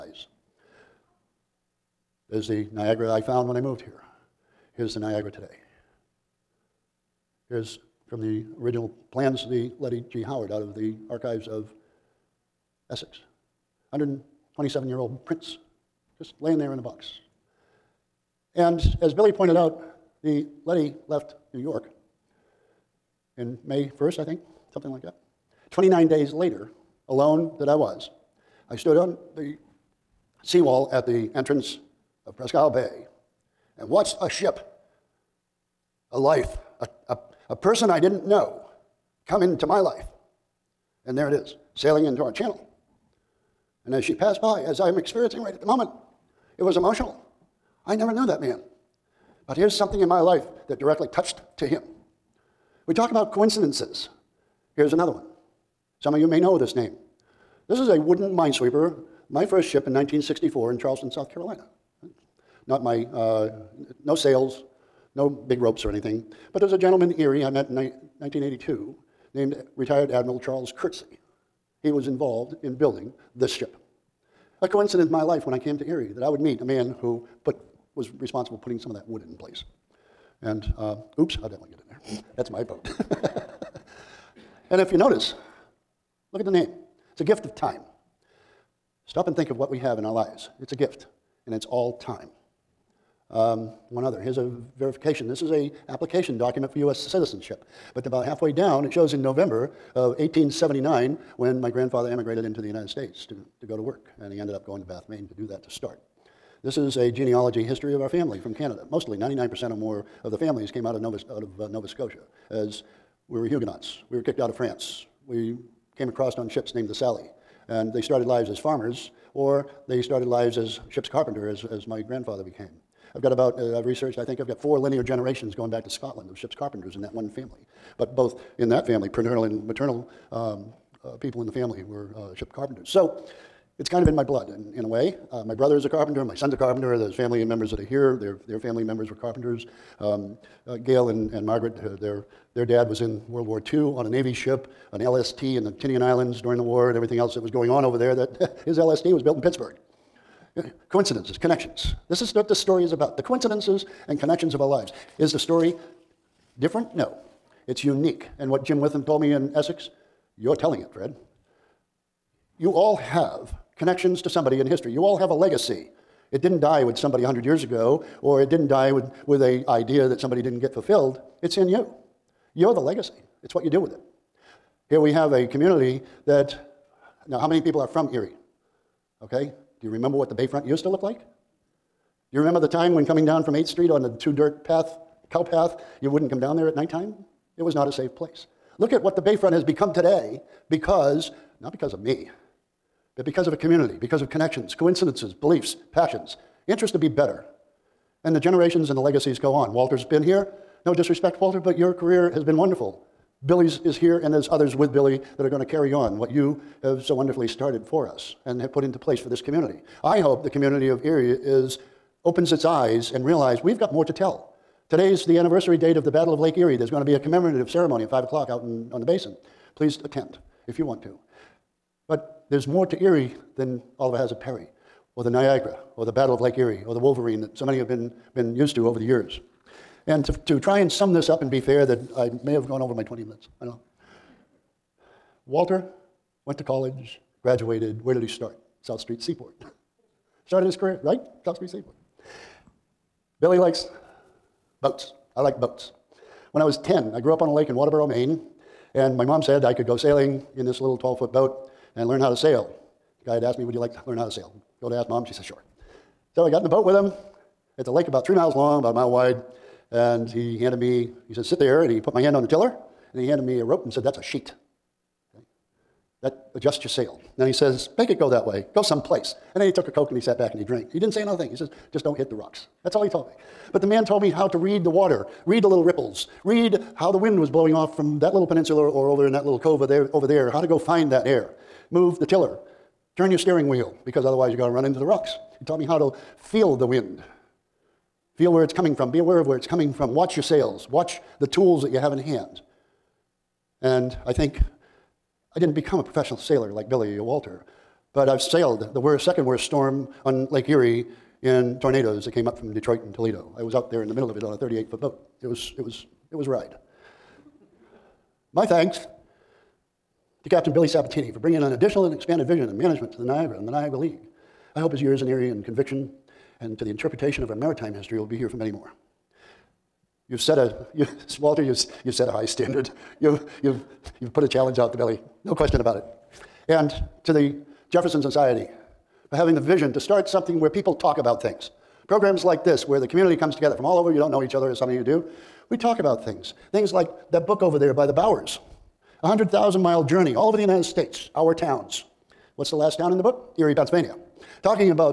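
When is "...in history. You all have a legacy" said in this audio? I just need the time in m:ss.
2:44.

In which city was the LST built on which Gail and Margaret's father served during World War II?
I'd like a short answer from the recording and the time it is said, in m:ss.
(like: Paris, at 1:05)
Pittsburgh, at 2:29.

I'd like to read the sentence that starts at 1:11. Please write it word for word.
He was involved in building this ship.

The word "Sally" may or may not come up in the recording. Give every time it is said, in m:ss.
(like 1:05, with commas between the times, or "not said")
1:56.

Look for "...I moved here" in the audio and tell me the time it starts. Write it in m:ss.
0:03.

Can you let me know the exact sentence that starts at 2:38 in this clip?
And what Jim Witham told me in Essex, you're telling it, Fred.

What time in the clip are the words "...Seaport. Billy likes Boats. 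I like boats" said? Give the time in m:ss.
4:01.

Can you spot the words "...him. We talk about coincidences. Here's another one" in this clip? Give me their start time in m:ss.
0:51.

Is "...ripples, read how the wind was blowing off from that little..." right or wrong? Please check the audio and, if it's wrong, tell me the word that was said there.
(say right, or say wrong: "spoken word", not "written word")
right.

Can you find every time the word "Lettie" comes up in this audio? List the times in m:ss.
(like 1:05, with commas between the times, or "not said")
0:09, 0:20.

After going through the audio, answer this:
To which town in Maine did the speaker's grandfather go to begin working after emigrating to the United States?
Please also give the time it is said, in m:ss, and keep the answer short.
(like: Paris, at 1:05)
Bath, Maine, at 1:44.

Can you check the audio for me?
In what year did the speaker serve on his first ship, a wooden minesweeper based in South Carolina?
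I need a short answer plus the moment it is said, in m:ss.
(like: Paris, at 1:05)
1964, at 0:59.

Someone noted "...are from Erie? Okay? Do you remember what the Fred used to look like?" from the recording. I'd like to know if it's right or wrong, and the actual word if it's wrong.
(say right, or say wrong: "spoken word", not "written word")
wrong: "Bayfront", not "Fred".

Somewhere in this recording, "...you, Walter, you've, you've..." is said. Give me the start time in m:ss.
5:20.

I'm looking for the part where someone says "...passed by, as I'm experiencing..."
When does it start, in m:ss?
0:44.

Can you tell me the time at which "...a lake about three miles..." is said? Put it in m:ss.
4:17.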